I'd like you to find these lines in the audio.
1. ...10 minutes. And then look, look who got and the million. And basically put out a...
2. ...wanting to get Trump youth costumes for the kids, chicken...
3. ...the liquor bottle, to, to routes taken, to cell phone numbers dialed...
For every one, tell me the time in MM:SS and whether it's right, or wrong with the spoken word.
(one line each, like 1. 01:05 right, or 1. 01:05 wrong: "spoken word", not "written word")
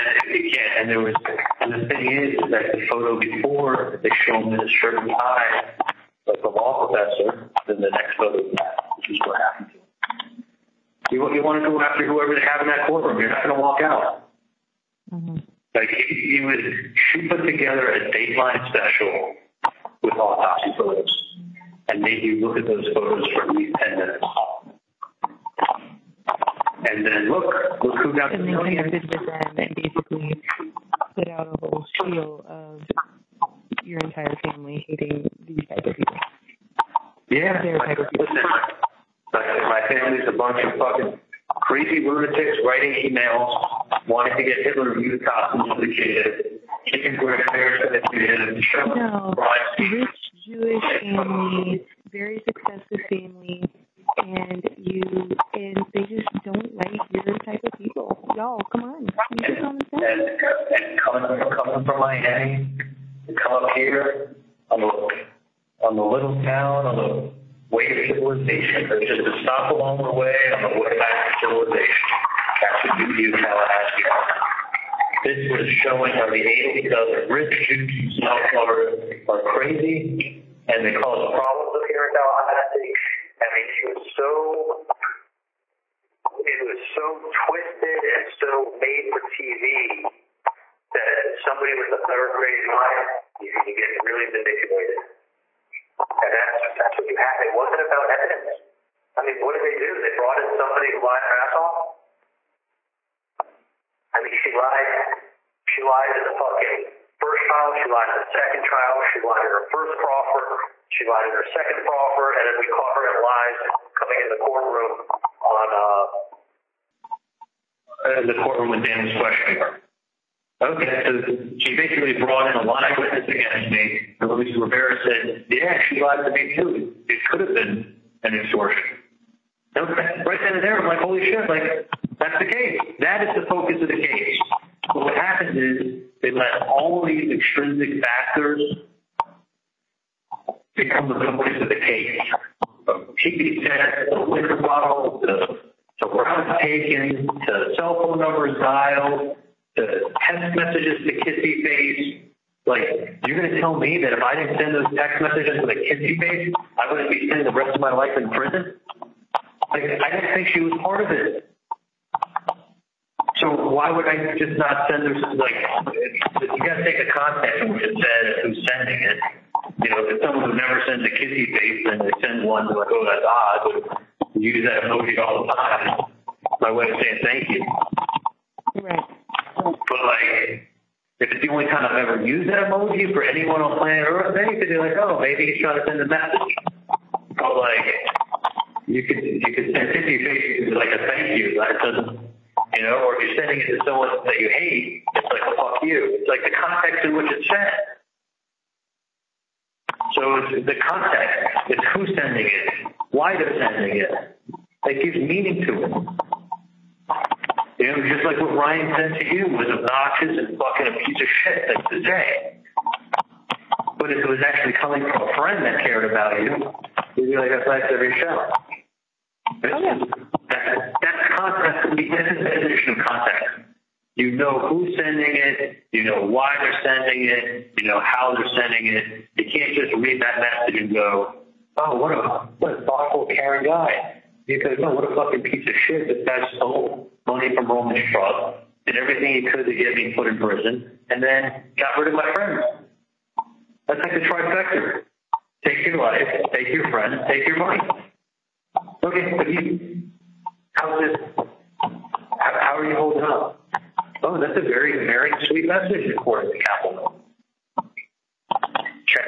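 1. 00:23 right
2. 00:44 wrong: "Hitler", not "Trump"
3. 02:24 right.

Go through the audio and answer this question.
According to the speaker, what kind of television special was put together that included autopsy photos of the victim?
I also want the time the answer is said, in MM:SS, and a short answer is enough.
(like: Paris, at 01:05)
Dateline special, at 00:18.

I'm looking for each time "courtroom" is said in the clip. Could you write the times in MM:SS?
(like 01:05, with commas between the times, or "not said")
00:12, 01:54, 01:58.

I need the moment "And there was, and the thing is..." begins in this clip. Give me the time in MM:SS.
00:00.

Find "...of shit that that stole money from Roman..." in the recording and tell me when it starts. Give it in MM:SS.
03:55.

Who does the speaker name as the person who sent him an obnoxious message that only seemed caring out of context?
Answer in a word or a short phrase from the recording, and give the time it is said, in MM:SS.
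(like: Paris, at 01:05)
Ryan, at 03:28.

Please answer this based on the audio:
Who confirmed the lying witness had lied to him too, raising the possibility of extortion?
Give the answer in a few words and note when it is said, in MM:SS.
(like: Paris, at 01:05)
Luis Rivera, at 02:04.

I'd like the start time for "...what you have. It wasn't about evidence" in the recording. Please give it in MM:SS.
01:36.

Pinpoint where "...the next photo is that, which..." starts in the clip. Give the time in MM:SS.
00:07.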